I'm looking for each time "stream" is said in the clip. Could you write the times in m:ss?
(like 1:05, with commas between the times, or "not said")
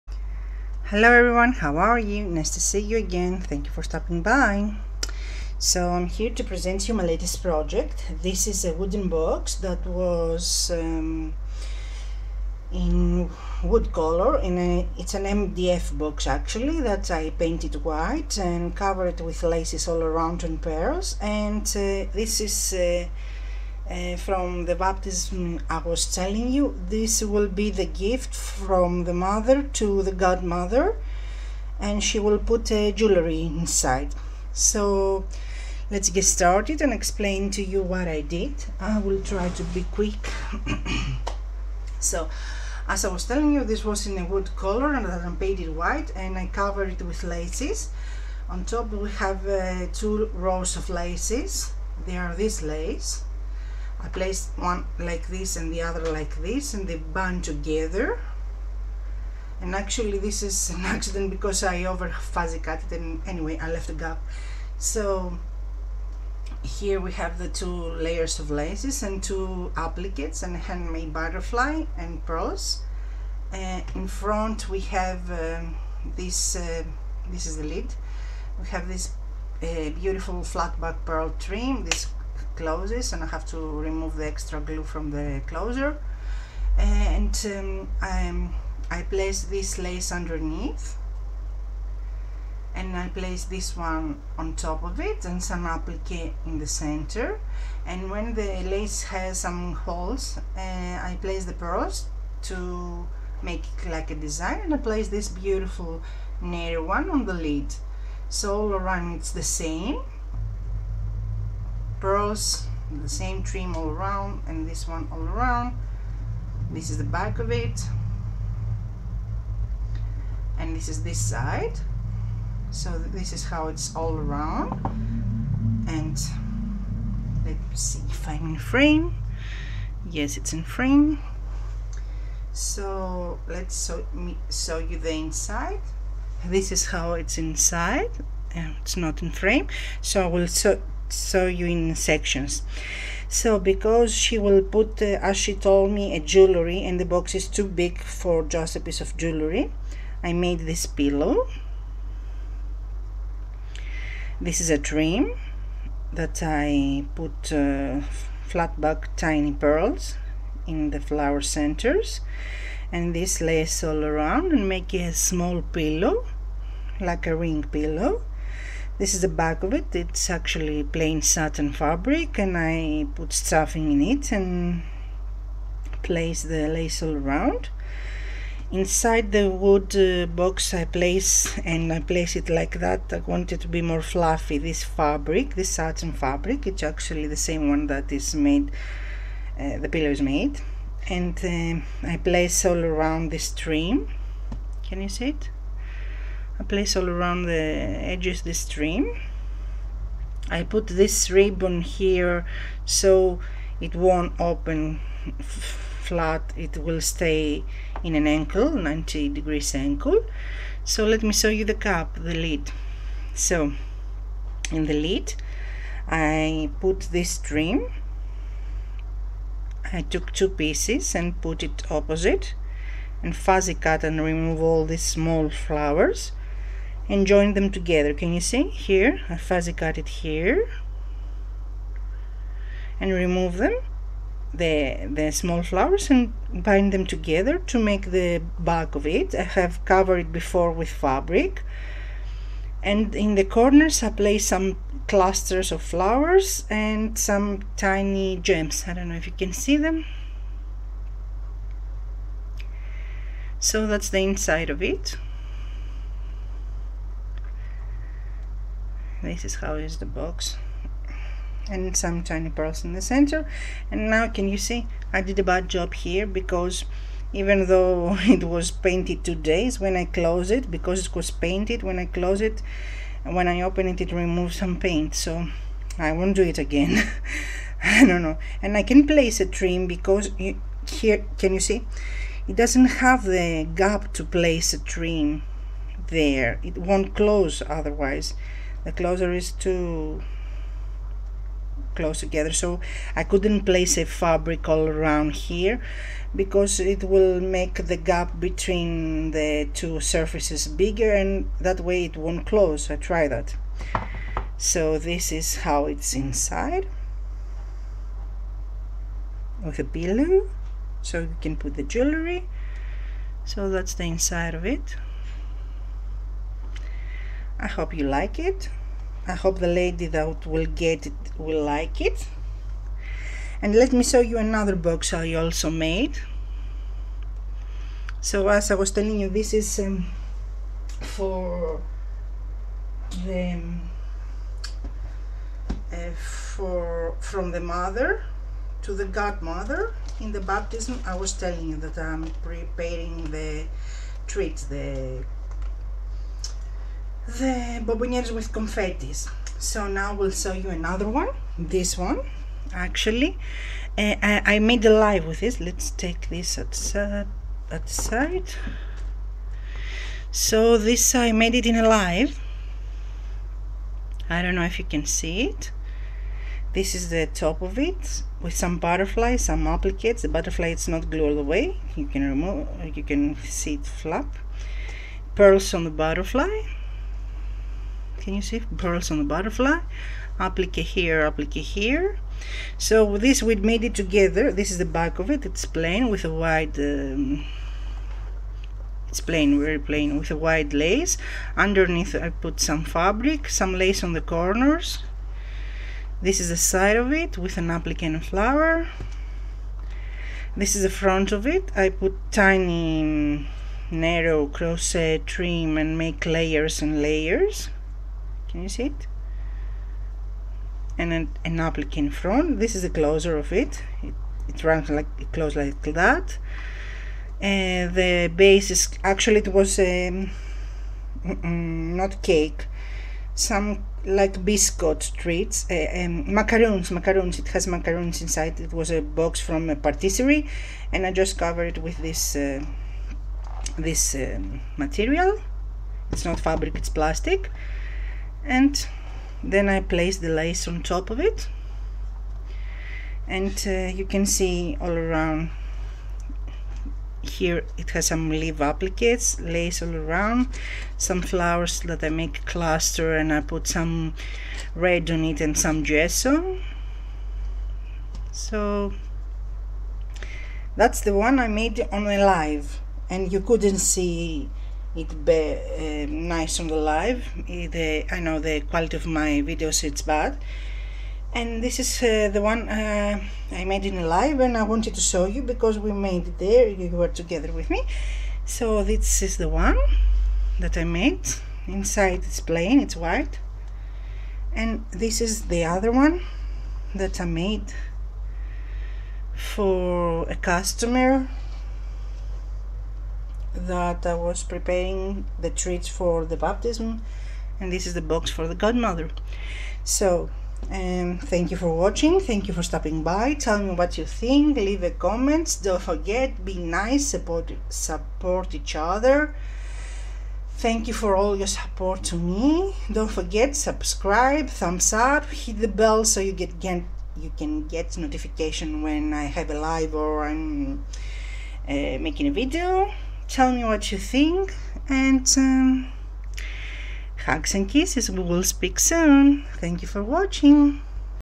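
3:13, 3:18.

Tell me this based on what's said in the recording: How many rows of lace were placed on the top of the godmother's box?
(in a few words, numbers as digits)
2.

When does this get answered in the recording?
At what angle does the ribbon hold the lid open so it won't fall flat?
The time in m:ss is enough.
3:28.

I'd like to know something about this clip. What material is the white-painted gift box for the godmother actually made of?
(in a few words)
MDF.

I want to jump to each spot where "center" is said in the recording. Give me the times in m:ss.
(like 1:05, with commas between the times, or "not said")
1:36, 2:41, 4:23.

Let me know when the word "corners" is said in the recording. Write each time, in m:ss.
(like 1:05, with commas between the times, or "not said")
4:03, 6:34.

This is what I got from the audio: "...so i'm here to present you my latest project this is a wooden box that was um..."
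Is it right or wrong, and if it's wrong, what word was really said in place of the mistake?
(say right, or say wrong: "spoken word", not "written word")
right.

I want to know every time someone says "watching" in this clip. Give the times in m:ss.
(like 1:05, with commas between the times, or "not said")
8:21, 8:50.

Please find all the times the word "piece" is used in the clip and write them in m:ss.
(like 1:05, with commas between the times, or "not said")
2:28, 3:40.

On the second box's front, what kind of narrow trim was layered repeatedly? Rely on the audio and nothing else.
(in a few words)
crochet trim.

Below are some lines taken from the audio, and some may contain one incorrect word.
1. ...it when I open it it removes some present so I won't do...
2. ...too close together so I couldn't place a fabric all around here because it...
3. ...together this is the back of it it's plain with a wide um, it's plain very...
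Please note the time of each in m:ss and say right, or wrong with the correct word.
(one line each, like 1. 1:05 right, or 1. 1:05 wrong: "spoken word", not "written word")
1. 4:32 wrong: "paint", not "present"
2. 4:49 right
3. 6:23 right.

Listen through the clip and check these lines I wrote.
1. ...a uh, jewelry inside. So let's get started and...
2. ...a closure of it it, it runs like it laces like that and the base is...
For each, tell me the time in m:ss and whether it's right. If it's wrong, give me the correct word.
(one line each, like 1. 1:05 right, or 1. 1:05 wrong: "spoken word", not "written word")
1. 0:32 right
2. 6:52 wrong: "closes", not "laces".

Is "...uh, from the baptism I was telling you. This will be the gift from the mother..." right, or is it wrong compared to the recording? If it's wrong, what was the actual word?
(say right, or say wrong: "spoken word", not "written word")
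right.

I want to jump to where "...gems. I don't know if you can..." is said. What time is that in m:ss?
4:08.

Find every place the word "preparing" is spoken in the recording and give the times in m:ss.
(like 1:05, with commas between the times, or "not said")
5:42, 8:14.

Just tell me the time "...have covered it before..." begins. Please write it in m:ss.
3:59.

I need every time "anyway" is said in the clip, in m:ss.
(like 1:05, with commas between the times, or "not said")
1:03.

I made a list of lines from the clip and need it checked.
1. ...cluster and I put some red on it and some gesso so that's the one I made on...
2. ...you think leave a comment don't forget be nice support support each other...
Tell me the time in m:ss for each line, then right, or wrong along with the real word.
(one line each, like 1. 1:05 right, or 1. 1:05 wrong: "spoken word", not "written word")
1. 7:32 right
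2. 8:23 right.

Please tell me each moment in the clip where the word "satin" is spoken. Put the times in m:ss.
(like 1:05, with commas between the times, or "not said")
2:51, 3:05.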